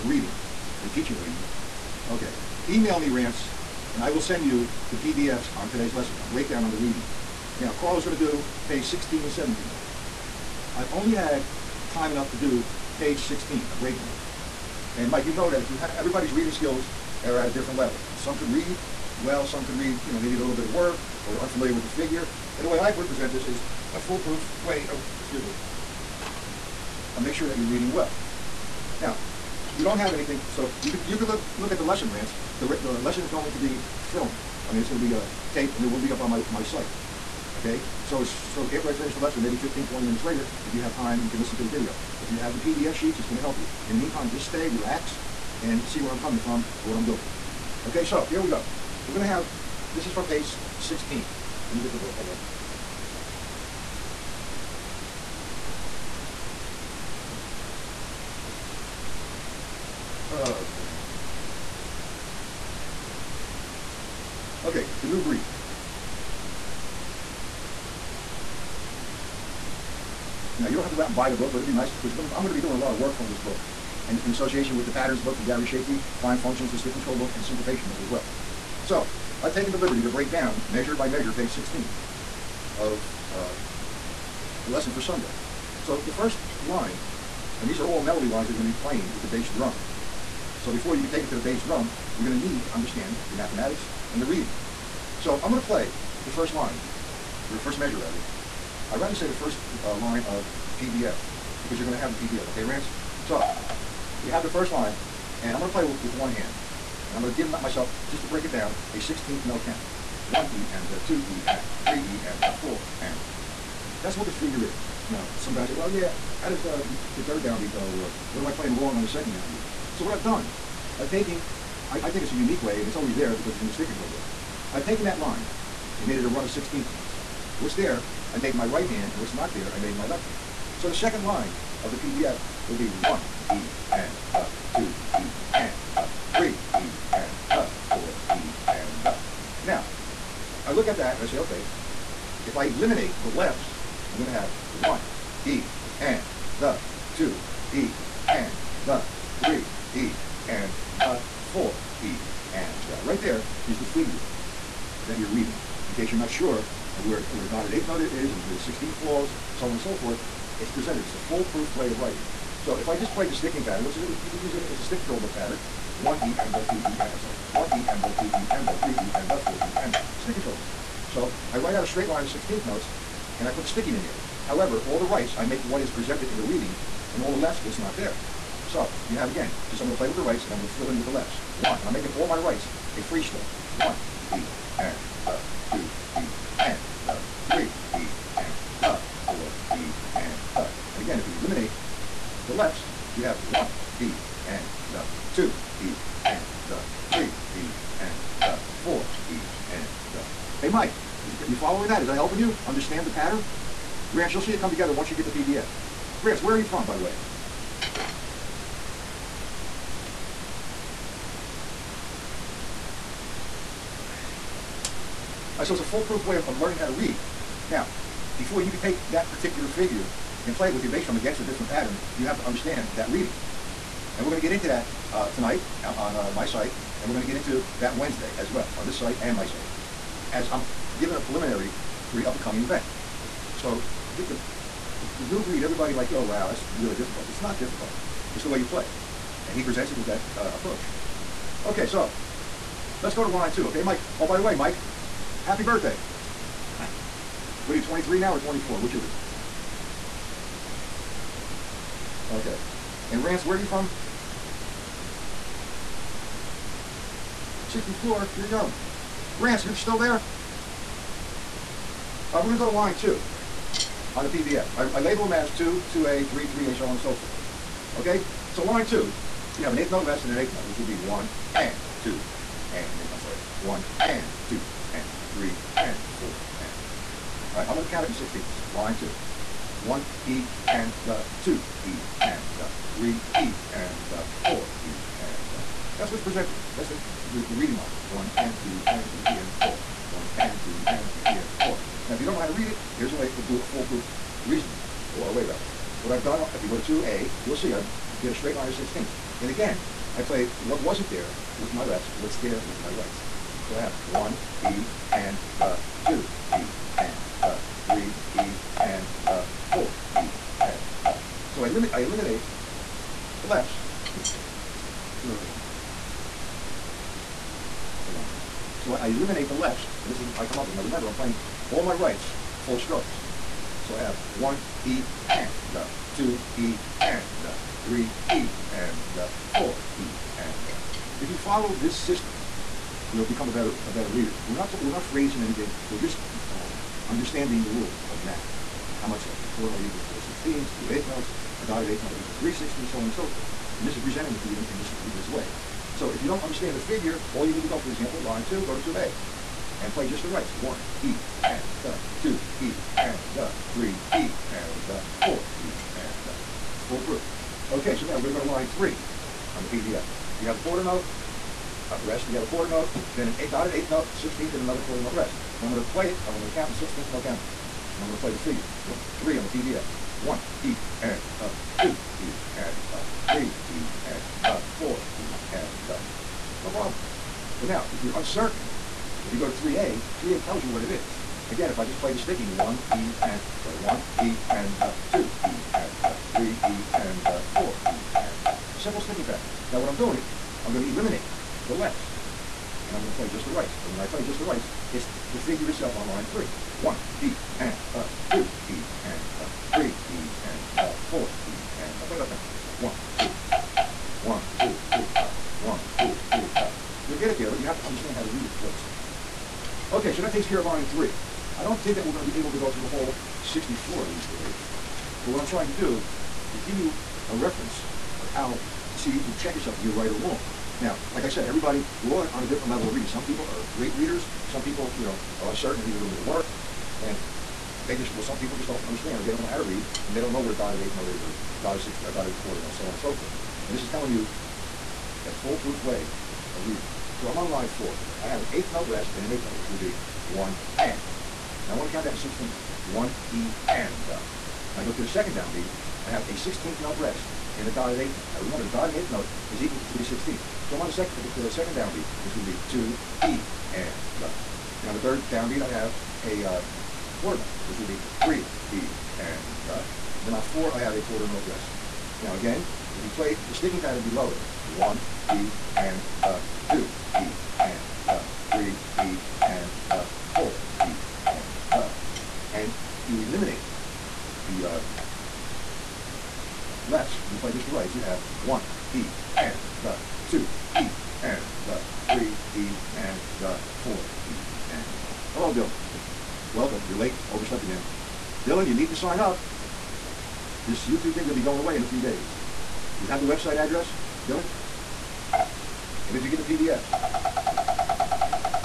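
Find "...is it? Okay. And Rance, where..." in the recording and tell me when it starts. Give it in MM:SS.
04:08.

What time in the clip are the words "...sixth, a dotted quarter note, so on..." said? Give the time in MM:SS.
07:11.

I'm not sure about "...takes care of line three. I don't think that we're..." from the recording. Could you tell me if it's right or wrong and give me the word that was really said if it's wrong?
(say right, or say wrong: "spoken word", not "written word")
right.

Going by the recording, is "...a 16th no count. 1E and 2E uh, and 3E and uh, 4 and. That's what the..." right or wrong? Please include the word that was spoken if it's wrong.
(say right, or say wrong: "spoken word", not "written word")
right.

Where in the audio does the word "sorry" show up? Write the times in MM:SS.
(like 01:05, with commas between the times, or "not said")
02:47, 04:33, 06:23.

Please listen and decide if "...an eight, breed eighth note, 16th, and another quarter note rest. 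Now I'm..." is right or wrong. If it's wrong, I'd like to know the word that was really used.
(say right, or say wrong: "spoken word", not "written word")
wrong: "dotted", not "breed".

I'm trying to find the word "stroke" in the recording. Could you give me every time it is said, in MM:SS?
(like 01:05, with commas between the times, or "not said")
03:03, 05:22.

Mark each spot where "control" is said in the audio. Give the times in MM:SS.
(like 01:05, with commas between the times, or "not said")
01:16, 02:03, 02:45, 02:50.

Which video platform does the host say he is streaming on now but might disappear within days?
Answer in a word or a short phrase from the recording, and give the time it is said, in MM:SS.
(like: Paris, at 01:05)
YouTube, at 08:10.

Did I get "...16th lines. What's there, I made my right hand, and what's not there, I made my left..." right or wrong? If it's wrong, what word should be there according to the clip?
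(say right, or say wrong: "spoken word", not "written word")
wrong: "notes", not "lines".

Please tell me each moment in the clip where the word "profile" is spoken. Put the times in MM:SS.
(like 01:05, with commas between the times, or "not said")
not said.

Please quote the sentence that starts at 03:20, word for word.
Hey, Mike, is, you following that?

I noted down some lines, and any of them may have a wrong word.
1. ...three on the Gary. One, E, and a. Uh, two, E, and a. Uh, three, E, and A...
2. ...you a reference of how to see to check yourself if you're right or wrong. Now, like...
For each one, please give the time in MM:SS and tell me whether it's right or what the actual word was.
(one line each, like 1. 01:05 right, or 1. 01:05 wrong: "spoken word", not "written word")
1. 06:09 wrong: "PDF", not "Gary"
2. 06:56 right.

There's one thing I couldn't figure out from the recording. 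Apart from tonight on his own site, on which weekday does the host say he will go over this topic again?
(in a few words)
Wednesday.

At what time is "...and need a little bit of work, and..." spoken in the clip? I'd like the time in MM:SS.
07:05.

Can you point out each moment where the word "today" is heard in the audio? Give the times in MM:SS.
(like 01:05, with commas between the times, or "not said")
00:05, 06:54.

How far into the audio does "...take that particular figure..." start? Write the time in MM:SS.
03:38.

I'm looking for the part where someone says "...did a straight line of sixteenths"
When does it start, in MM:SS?
04:58.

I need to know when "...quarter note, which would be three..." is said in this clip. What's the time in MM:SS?
07:37.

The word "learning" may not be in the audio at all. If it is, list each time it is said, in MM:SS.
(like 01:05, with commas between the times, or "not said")
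03:36.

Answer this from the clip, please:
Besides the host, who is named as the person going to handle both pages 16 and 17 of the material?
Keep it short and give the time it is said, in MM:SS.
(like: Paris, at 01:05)
Carl, at 00:07.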